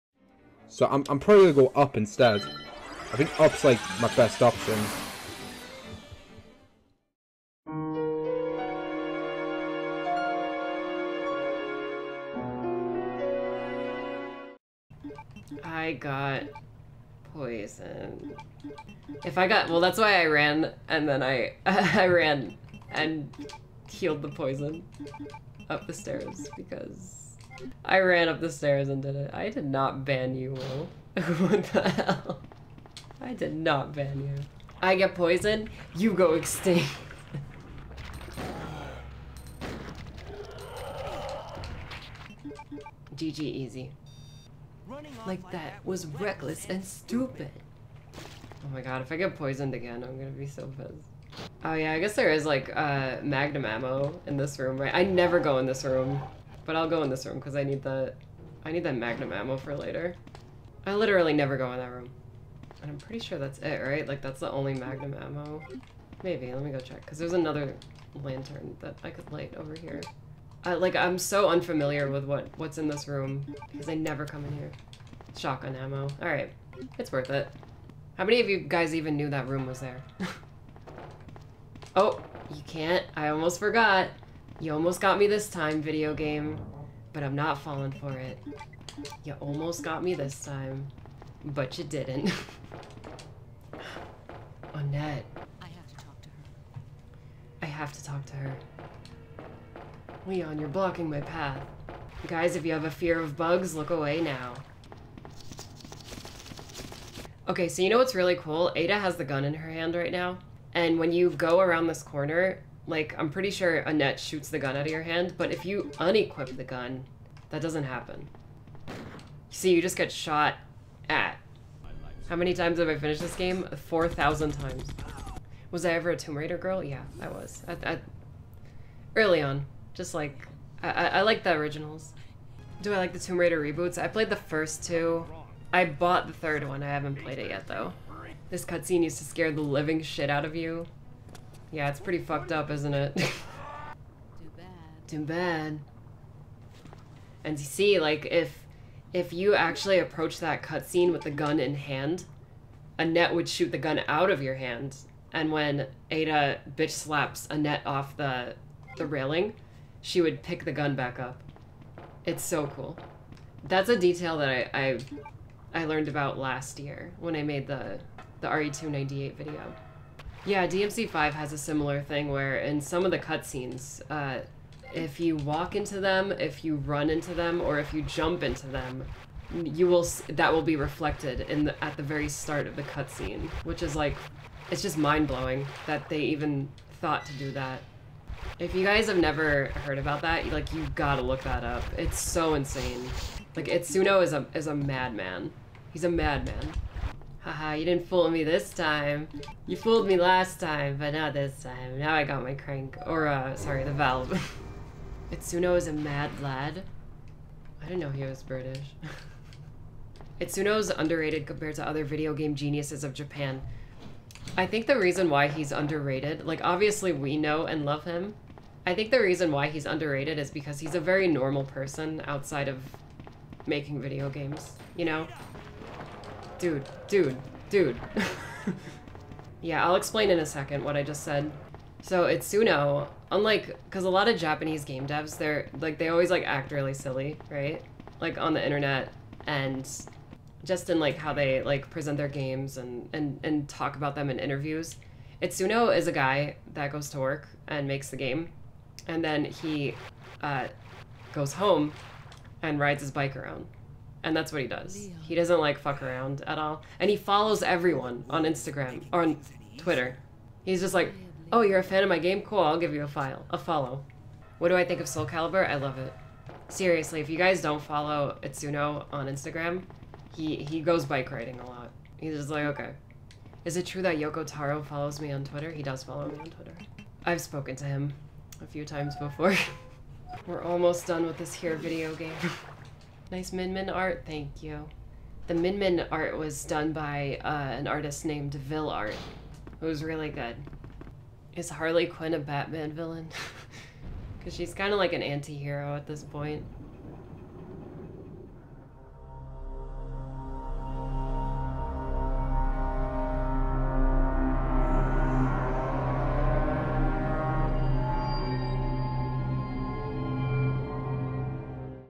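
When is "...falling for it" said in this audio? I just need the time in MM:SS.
01:27.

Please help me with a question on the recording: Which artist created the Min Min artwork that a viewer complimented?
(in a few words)
Vil Art.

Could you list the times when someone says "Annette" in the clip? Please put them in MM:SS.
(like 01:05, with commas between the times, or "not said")
01:34, 01:53, 02:32, 02:37.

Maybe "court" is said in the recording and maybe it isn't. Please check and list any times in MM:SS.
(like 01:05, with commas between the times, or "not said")
not said.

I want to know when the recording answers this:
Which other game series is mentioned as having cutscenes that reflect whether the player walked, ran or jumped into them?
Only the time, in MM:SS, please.
02:50.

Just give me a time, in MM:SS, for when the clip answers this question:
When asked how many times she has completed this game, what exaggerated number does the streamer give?
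02:03.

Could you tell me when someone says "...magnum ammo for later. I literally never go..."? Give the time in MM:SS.
00:58.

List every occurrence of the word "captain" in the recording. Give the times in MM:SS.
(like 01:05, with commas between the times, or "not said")
not said.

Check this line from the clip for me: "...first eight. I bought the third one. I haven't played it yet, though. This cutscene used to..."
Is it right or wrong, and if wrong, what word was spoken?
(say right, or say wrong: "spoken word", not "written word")
wrong: "two", not "eight".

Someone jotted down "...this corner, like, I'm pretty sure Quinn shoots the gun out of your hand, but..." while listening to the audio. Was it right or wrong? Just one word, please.
wrong.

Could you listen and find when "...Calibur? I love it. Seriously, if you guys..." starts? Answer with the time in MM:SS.
04:25.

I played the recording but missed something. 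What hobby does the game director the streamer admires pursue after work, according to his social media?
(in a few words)
Bike riding.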